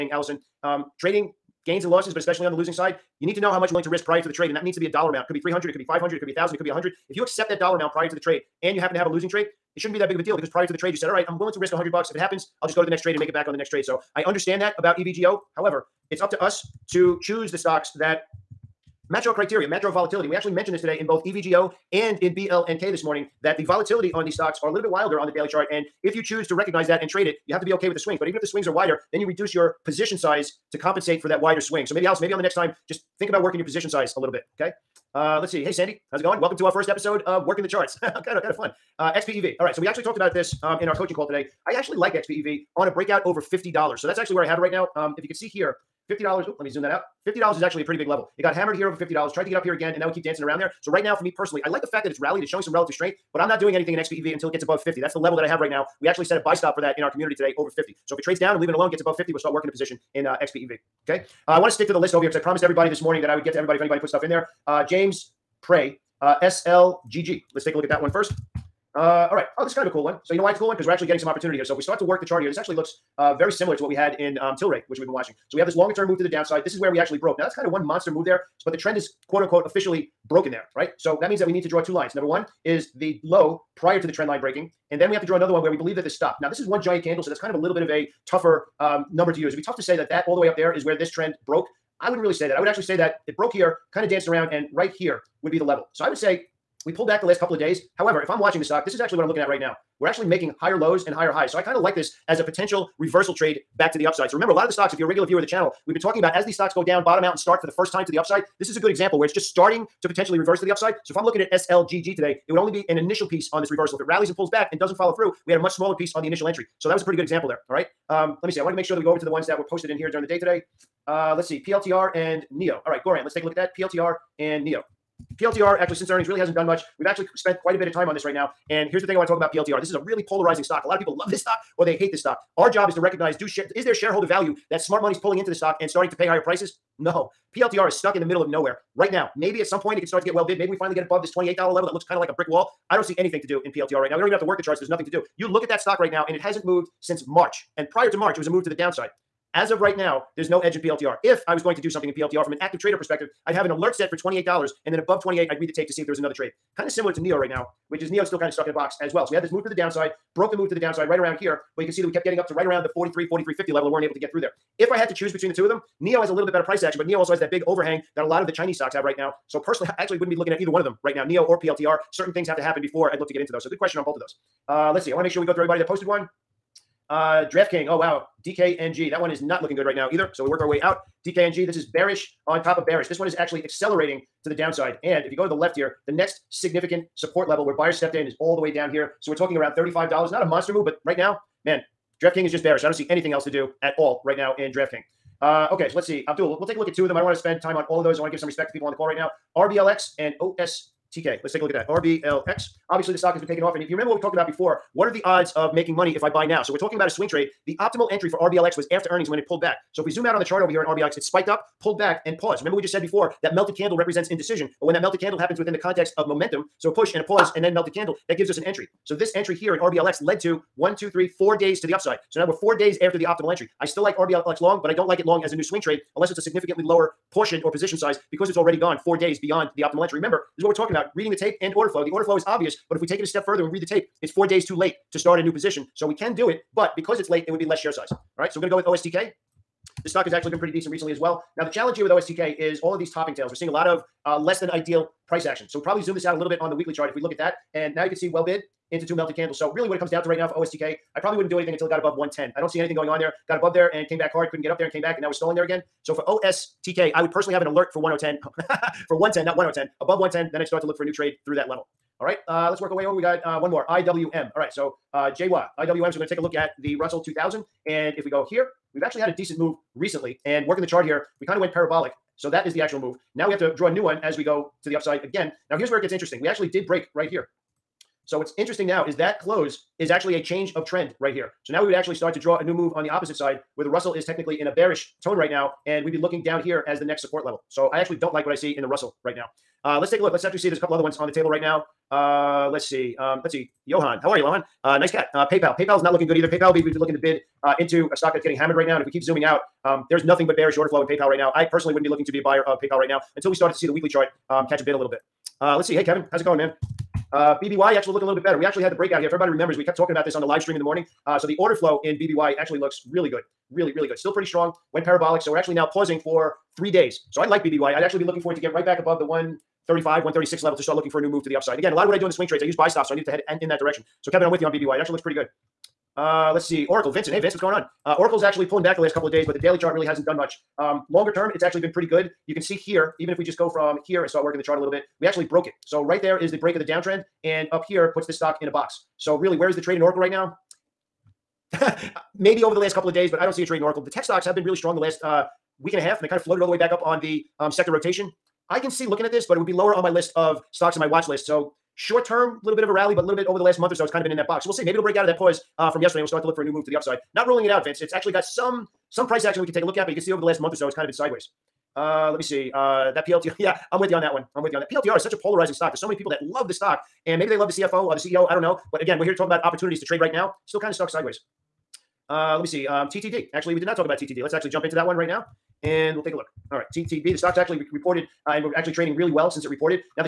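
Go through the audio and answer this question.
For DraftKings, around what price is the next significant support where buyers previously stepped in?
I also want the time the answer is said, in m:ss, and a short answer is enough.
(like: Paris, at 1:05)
$35, at 3:09.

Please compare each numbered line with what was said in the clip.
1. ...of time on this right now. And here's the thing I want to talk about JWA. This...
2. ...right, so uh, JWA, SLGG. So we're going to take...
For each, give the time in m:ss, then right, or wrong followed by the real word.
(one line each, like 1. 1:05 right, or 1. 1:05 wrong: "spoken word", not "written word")
1. 2:07 wrong: "PLTR", not "JWA"
2. 4:24 wrong: "IWM", not "SLGG".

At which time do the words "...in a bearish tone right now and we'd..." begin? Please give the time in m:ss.
4:44.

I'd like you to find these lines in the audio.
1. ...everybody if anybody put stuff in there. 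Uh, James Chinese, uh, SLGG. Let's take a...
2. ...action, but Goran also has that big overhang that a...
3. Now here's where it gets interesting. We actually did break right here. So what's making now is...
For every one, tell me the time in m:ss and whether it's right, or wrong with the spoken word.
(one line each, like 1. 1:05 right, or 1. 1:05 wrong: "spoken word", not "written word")
1. 1:03 wrong: "Prey", not "Chinese"
2. 2:46 wrong: "NIO", not "Goran"
3. 4:35 wrong: "interesting", not "making".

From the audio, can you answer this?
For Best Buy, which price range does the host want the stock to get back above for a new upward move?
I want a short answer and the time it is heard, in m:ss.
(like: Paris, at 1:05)
135 to 136, at 5:19.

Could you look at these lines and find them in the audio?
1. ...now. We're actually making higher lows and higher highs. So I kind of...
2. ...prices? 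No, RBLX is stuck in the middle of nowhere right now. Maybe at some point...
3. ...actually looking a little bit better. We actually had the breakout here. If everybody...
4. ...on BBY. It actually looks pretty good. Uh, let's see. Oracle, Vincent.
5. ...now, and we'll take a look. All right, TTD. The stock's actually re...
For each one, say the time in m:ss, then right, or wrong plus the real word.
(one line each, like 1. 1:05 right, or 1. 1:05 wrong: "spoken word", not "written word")
1. 1:39 right
2. 2:16 wrong: "PLTR", not "RBLX"
3. 5:07 right
4. 5:24 right
5. 6:15 right.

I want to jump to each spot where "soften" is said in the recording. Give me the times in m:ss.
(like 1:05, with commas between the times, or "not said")
not said.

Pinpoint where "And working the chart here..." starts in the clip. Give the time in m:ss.
4:30.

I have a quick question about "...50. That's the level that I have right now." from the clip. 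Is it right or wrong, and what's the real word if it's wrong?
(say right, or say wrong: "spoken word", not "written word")
right.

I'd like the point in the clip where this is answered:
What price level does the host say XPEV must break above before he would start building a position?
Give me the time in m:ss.
0:42.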